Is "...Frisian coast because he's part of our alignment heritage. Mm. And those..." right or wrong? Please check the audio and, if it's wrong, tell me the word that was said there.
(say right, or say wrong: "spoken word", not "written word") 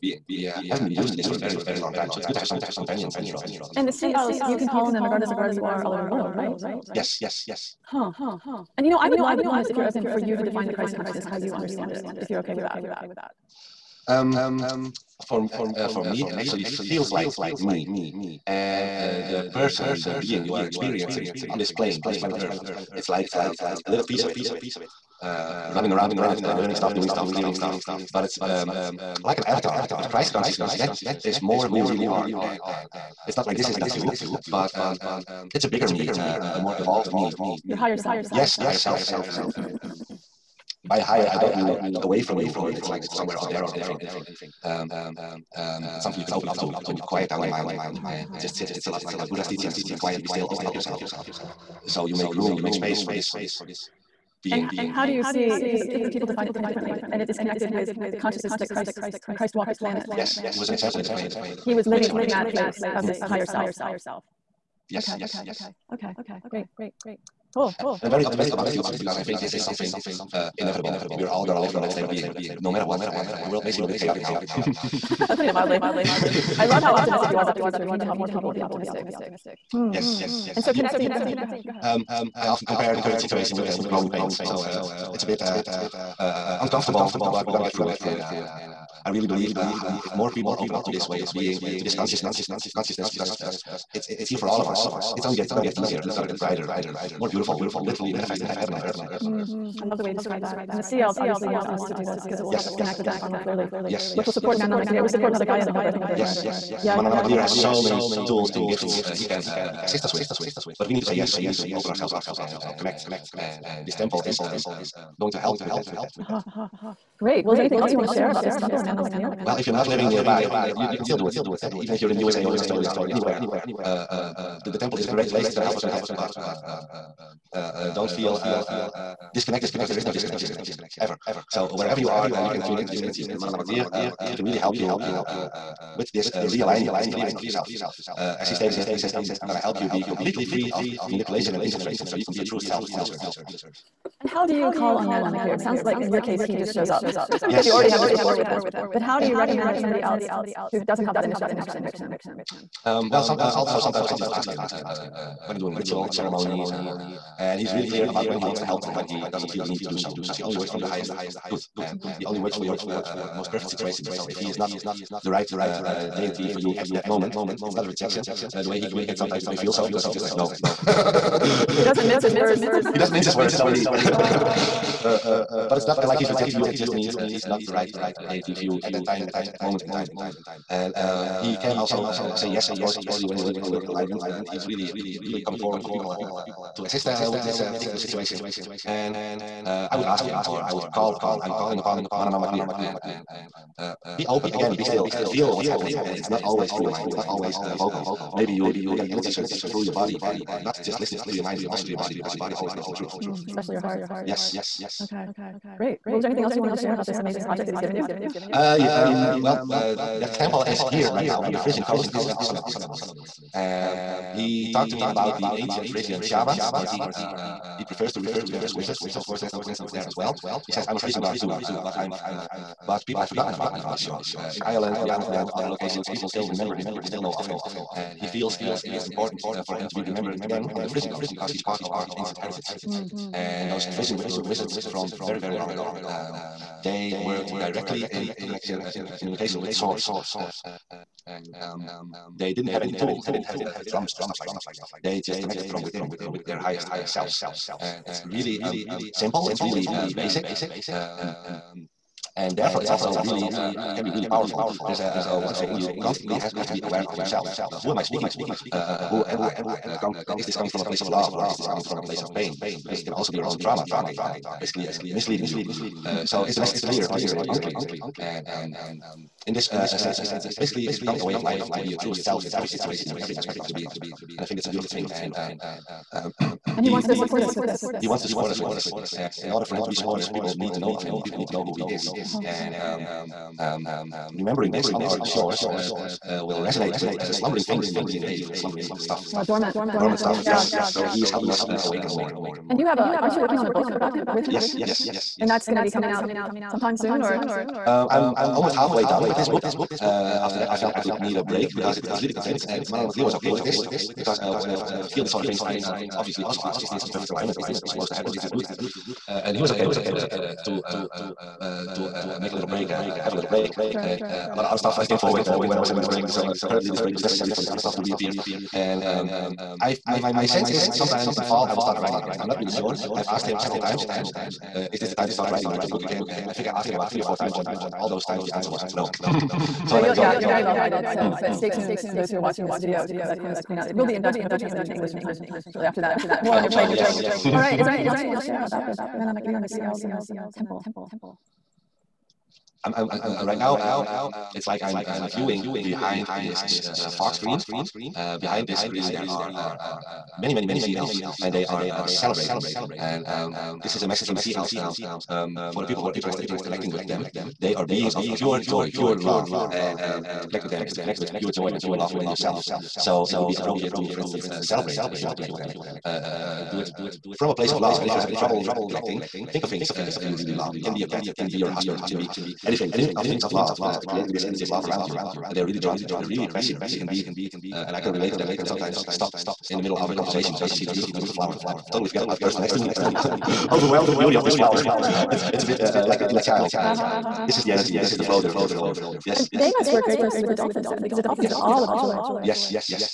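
wrong: "ancient", not "alignment".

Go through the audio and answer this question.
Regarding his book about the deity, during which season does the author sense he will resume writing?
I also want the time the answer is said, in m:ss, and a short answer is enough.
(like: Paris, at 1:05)
Fall, at 5:21.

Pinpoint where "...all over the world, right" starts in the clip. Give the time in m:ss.
0:05.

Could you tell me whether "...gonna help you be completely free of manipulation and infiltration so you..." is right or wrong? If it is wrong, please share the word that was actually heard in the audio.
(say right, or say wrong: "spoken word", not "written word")
right.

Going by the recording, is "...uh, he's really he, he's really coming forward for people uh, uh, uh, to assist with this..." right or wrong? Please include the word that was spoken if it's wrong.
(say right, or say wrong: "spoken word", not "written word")
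right.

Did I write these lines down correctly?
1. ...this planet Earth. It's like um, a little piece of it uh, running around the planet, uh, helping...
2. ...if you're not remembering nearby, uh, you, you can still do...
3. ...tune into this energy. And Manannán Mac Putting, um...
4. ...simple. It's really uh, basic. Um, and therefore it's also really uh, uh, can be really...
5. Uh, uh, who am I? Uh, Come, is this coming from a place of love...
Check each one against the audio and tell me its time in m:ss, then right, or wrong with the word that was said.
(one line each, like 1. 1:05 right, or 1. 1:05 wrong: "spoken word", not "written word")
1. 0:22 wrong: "learning", not "helping"
2. 1:59 wrong: "living", not "remembering"
3. 2:12 wrong: "Lir", not "Putting"
4. 4:09 right
5. 4:18 right.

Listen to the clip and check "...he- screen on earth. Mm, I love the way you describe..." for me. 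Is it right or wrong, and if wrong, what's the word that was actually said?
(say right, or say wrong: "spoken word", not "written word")
wrong: "heaven", not "screen".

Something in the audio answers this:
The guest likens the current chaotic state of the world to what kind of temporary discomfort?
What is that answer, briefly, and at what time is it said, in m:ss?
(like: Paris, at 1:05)
Growing pains, at 1:23.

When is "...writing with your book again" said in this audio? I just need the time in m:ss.
5:25.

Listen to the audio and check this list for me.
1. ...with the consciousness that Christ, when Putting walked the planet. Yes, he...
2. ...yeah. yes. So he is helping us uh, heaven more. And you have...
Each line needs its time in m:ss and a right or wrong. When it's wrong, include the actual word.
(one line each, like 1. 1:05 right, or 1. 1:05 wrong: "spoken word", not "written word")
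1. 0:57 wrong: "Christ", not "Putting"
2. 4:50 wrong: "awaken", not "heaven".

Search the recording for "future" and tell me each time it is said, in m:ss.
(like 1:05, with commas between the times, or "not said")
1:08, 1:17.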